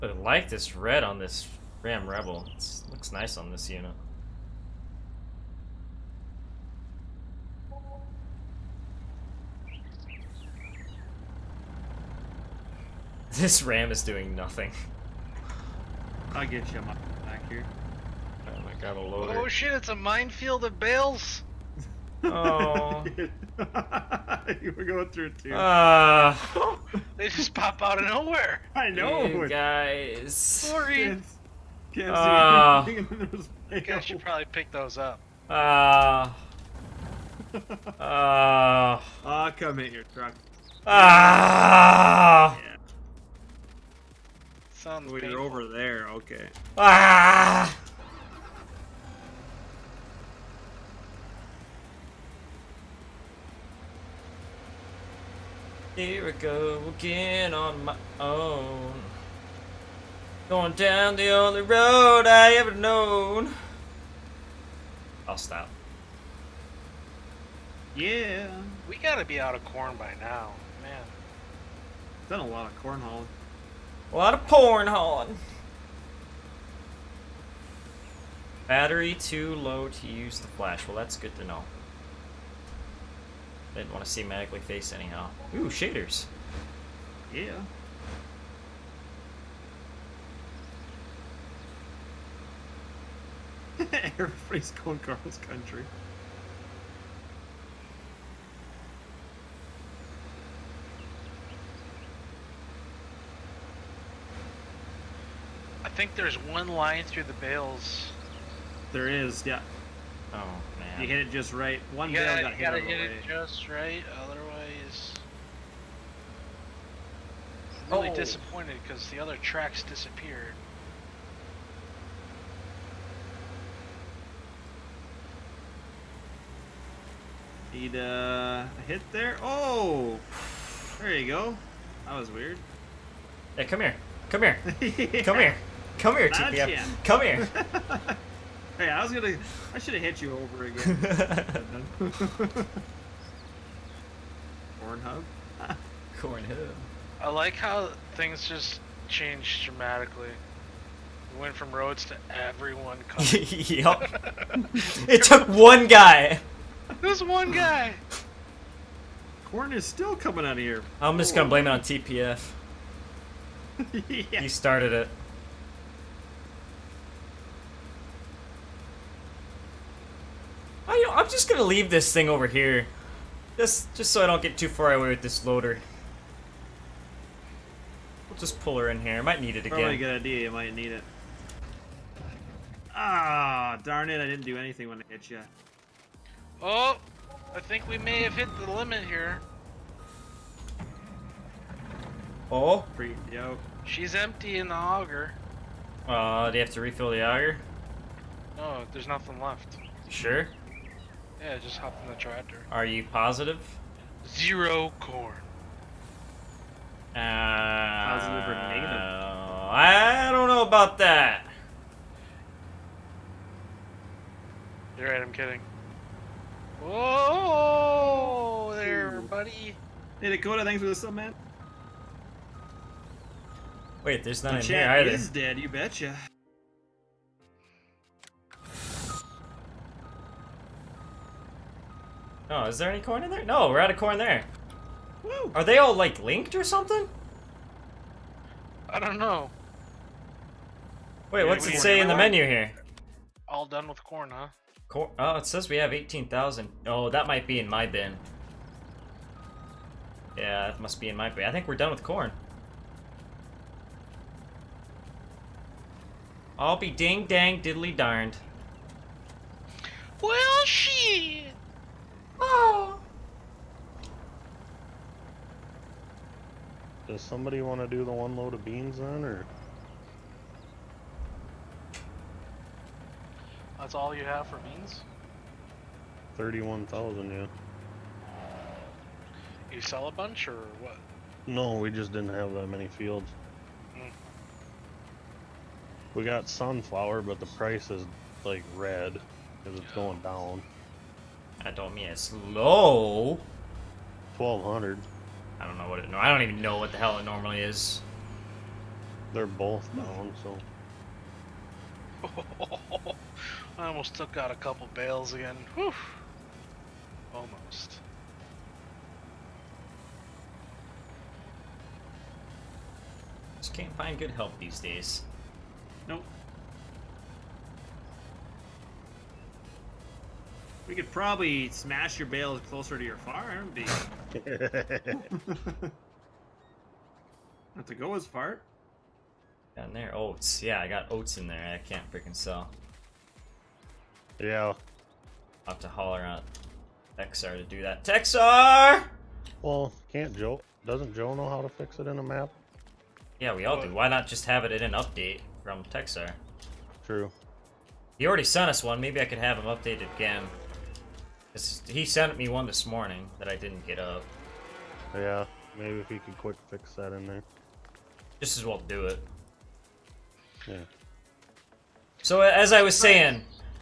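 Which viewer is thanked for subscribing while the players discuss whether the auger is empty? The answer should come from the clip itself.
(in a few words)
Dakota.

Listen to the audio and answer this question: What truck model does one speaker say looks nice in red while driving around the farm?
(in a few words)
Ram Rebel.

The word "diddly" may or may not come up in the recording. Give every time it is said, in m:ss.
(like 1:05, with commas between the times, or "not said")
4:17.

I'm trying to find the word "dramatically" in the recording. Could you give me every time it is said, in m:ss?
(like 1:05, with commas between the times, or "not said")
2:29.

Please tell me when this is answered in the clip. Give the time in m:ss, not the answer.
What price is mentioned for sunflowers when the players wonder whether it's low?
4:54.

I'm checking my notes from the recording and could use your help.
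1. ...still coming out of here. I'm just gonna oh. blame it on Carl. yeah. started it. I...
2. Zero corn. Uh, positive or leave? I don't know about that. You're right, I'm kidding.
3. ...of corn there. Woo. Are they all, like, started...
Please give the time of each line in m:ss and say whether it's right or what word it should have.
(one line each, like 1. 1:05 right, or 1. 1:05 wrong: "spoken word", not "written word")
1. 2:39 wrong: "TPF", not "Carl"
2. 3:24 wrong: "negative", not "leave"
3. 3:53 wrong: "linked", not "started".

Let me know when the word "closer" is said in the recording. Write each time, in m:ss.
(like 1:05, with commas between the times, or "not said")
5:22.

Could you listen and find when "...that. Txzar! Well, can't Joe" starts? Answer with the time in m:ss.
5:37.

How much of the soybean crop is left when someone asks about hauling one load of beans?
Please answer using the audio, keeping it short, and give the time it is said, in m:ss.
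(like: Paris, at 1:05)
31,000, at 4:36.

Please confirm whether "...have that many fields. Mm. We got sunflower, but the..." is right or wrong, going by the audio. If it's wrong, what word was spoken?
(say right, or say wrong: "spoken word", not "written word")
right.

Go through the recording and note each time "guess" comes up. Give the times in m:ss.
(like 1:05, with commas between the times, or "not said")
0:33.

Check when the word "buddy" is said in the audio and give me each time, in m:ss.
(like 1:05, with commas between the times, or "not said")
3:39.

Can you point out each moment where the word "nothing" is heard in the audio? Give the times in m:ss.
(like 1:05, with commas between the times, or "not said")
0:14, 3:19.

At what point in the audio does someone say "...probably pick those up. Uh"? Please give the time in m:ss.
0:34.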